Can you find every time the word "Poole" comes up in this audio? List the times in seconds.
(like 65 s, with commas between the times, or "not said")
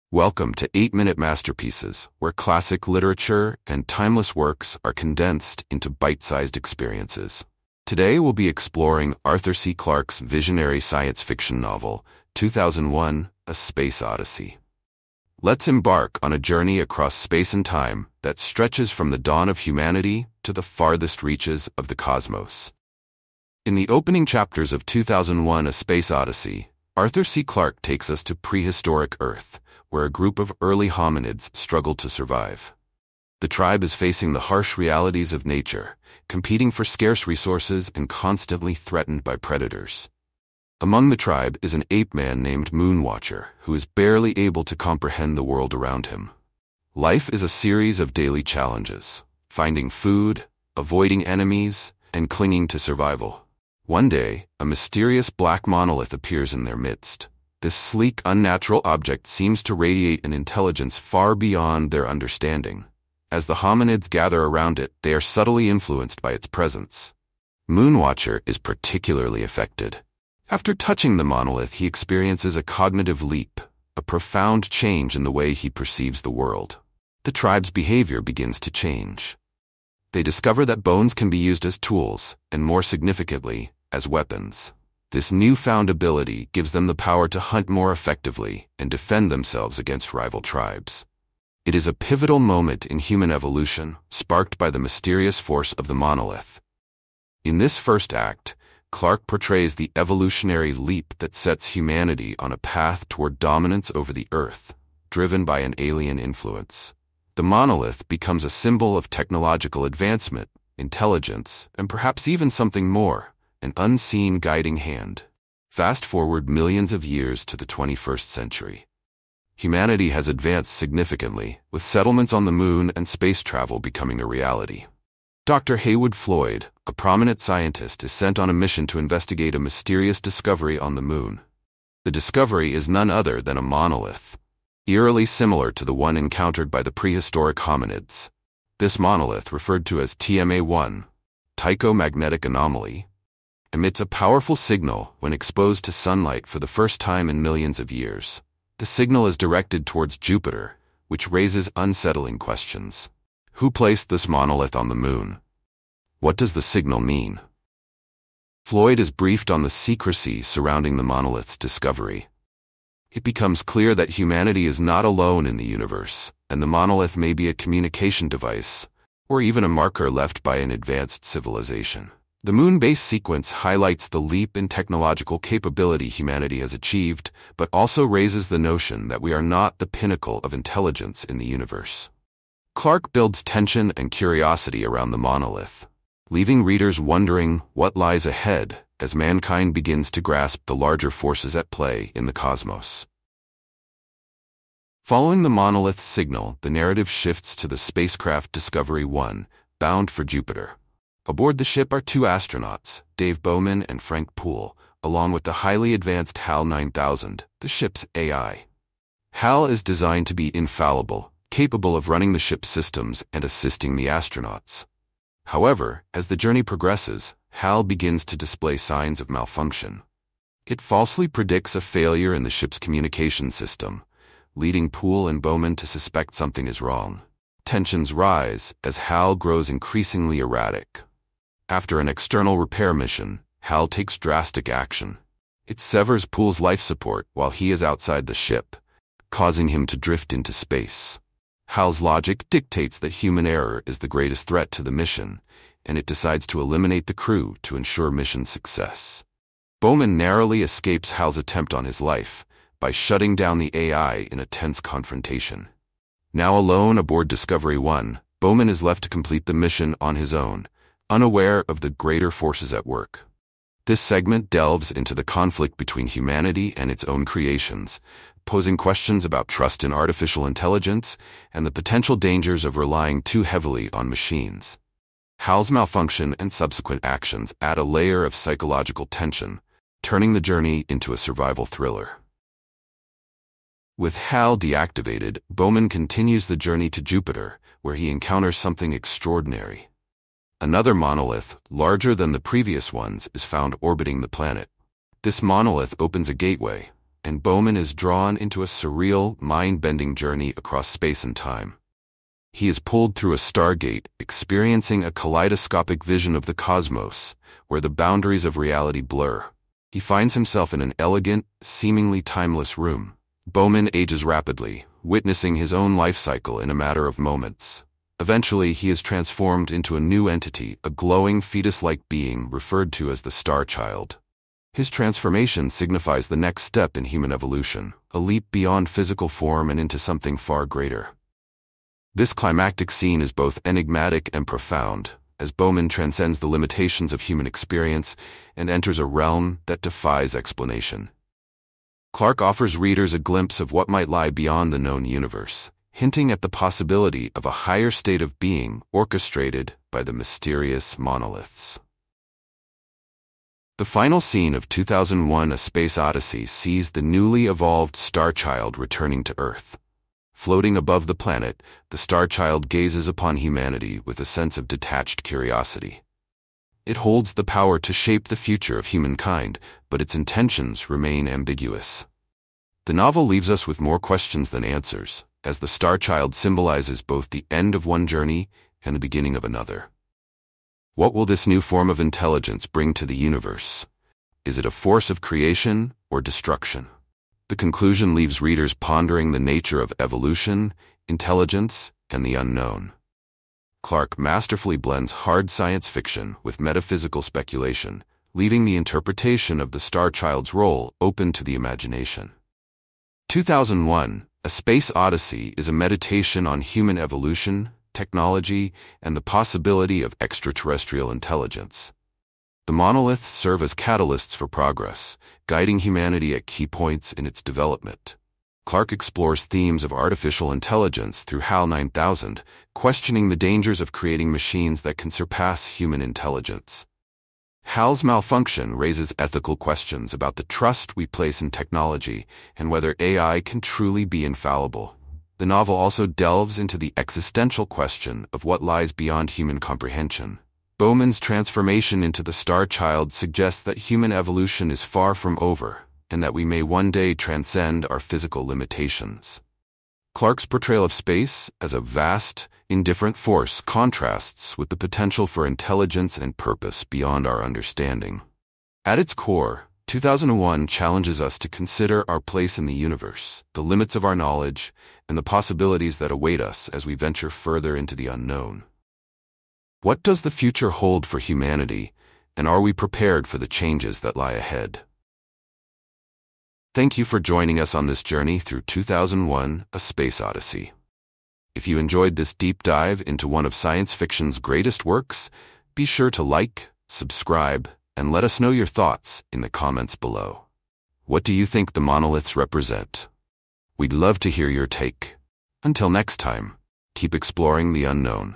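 204 s, 224 s, 236 s.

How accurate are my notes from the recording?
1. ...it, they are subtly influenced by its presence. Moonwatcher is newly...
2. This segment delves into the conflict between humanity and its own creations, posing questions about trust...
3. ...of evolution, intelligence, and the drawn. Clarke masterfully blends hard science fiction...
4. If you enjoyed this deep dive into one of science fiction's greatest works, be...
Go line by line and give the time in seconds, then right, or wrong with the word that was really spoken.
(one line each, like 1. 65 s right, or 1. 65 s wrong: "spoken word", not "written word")
1. 64 s wrong: "particularly", not "newly"
2. 263 s right
3. 389 s wrong: "unknown", not "drawn"
4. 481 s right.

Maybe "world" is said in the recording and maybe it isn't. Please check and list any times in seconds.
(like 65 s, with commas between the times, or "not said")
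45 s, 76 s.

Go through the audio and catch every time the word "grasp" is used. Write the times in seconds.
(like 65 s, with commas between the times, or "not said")
190 s.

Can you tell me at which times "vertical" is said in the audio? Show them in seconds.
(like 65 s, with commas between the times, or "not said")
not said.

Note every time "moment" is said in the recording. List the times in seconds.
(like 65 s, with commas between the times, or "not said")
92 s, 317 s.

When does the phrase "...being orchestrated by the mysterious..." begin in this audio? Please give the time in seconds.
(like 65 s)
348 s.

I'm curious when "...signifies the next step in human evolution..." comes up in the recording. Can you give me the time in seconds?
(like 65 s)
325 s.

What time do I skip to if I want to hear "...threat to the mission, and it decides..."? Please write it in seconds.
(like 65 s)
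244 s.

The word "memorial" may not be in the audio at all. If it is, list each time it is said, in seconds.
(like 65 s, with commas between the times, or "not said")
not said.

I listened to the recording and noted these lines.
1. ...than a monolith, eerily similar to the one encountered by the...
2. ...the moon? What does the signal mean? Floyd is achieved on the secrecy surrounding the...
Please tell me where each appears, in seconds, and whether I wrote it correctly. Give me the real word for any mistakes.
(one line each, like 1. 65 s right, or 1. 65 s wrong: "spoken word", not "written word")
1. 133 s right
2. 154 s wrong: "briefed", not "achieved".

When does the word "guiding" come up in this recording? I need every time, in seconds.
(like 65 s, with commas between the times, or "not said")
114 s, 415 s.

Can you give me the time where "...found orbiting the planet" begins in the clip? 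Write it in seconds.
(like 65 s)
293 s.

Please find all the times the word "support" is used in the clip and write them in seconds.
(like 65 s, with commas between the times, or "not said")
236 s.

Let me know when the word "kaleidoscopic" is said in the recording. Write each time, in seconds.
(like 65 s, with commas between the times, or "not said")
305 s.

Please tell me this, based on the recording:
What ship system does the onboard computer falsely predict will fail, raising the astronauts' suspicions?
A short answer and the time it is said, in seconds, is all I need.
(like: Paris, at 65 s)
Communication system, at 222 s.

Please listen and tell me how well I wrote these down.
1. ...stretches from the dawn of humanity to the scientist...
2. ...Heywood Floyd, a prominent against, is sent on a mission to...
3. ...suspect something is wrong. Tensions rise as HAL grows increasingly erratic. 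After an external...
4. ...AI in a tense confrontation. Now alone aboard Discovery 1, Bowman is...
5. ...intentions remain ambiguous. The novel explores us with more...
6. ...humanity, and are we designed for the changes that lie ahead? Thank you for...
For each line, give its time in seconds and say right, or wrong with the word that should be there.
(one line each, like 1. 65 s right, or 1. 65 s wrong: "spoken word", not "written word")
1. 18 s wrong: "farthest", not "scientist"
2. 125 s wrong: "scientist", not "against"
3. 225 s right
4. 253 s right
5. 370 s wrong: "leaves", not "explores"
6. 471 s wrong: "prepared", not "designed".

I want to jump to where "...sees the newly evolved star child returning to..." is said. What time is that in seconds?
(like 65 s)
356 s.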